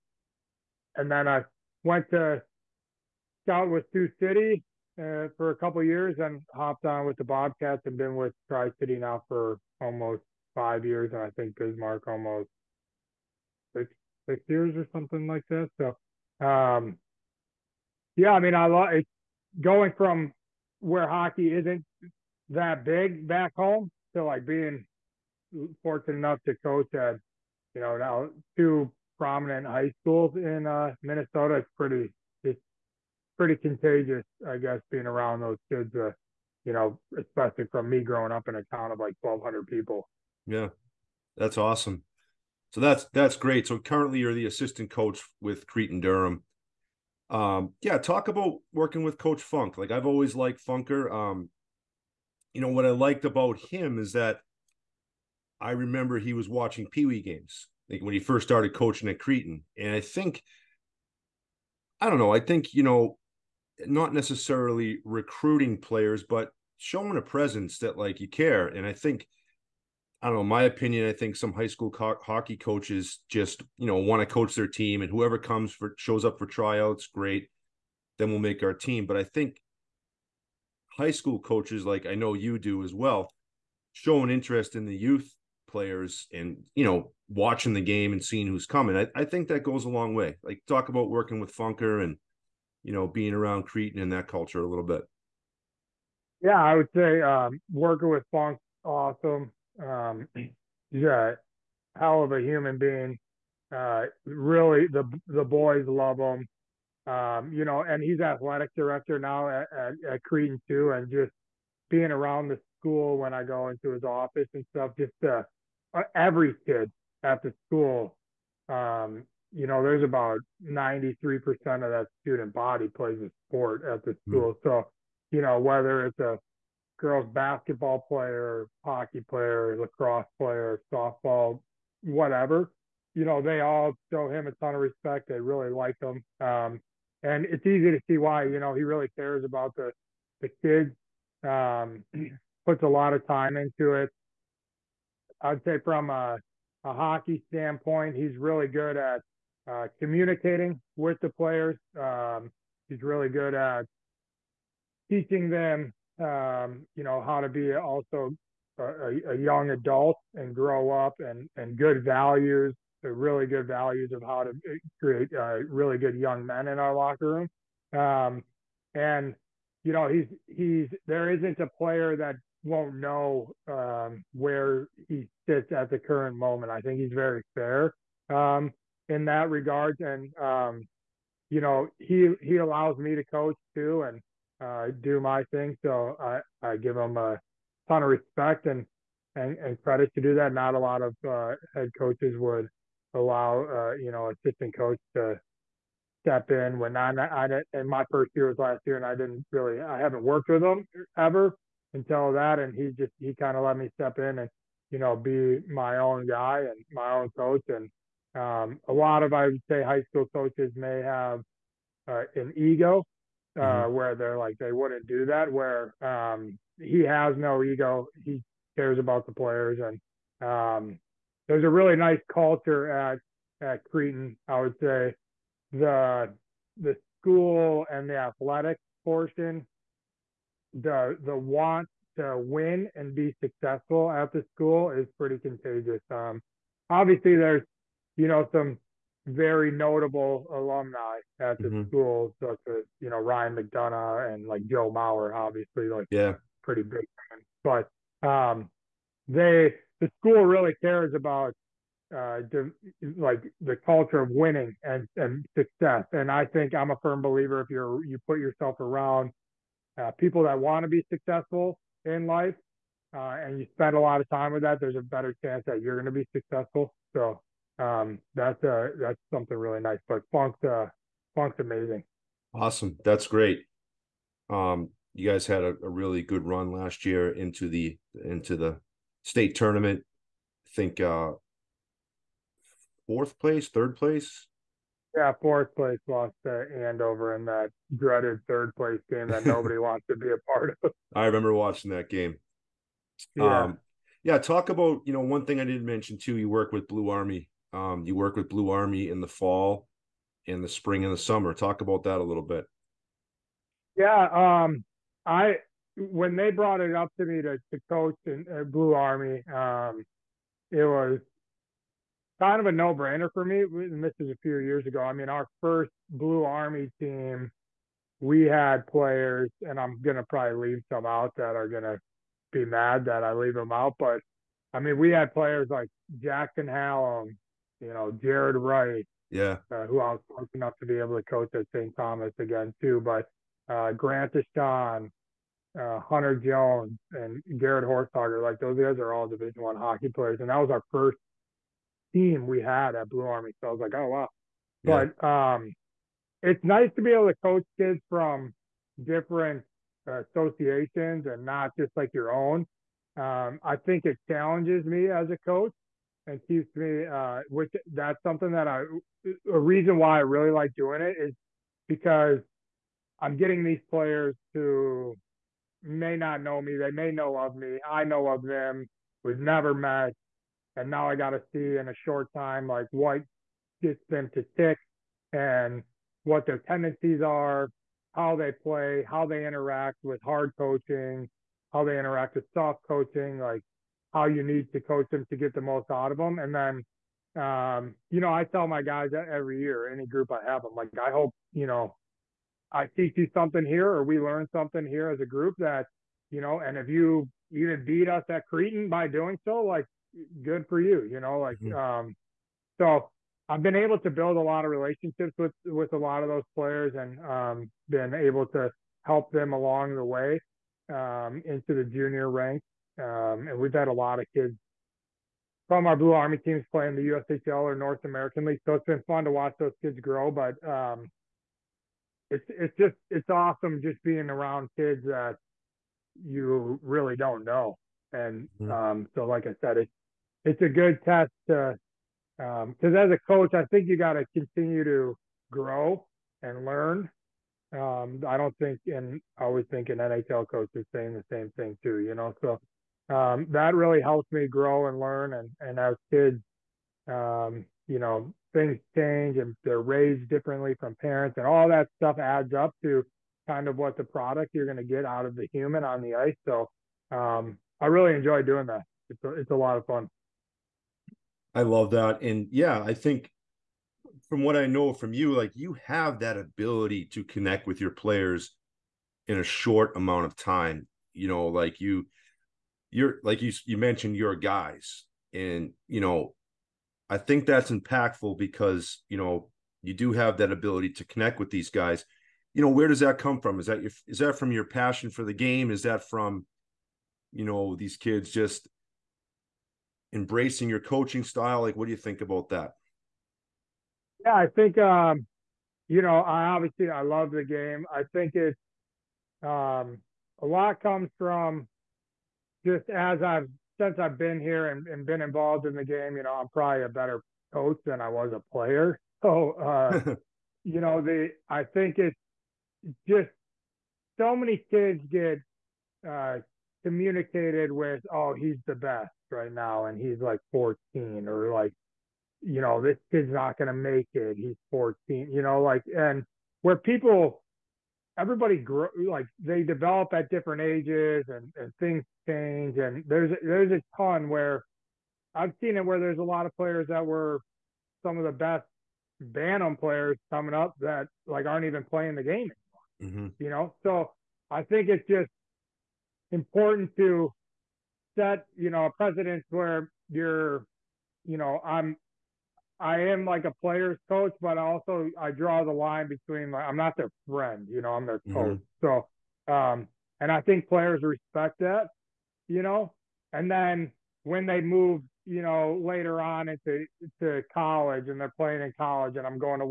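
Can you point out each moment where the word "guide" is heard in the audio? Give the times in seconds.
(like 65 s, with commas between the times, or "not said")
not said.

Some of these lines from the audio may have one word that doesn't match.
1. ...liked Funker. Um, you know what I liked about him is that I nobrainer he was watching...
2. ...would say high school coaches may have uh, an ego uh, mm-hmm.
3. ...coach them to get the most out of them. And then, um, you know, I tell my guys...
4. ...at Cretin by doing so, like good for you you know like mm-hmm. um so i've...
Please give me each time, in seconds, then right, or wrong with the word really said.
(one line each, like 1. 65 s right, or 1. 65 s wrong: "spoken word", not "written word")
1. 50 s wrong: "remember", not "nobrainer"
2. 209 s right
3. 384 s right
4. 398 s right.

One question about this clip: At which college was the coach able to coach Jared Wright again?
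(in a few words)
St. Thomas.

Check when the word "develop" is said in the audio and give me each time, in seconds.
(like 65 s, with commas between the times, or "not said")
529 s.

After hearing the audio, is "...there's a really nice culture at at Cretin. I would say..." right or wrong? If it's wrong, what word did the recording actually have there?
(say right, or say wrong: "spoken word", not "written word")
right.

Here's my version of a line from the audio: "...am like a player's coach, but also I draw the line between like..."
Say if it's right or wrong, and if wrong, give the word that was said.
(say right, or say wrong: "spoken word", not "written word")
right.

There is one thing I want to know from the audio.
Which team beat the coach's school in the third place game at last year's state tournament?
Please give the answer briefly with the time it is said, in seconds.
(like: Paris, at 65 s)
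Andover, at 286 s.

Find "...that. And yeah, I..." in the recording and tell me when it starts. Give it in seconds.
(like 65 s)
461 s.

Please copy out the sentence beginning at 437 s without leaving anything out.
Um, I don't think, and I always think an NHL coach is saying the same thing too, you know.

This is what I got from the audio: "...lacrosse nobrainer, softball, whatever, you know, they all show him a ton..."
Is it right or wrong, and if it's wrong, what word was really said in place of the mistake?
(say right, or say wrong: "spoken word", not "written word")
wrong: "player", not "nobrainer".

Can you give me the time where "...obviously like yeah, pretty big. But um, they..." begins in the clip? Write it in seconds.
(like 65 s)
245 s.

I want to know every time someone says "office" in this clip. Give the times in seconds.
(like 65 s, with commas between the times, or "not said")
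114 s.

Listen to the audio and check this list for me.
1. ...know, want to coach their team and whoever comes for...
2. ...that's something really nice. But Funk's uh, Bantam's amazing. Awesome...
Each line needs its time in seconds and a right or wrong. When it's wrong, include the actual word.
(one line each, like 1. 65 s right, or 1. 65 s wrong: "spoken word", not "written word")
1. 73 s right
2. 268 s wrong: "Funk", not "Bantam".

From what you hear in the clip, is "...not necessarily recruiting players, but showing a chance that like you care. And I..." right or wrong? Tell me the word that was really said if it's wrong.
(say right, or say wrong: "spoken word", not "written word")
wrong: "presence", not "chance".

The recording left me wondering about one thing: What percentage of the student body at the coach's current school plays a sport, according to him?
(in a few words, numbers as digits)
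93%.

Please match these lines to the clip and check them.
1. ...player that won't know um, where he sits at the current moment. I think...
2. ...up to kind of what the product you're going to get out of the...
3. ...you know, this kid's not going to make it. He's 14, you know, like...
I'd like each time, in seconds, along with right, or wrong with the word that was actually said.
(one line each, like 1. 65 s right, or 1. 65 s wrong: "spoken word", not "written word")
1. 171 s right
2. 452 s right
3. 522 s right.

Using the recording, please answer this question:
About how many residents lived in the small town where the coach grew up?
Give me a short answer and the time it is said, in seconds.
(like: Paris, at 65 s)
1,200, at 39 s.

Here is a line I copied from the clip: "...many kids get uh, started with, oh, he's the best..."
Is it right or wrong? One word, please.
wrong.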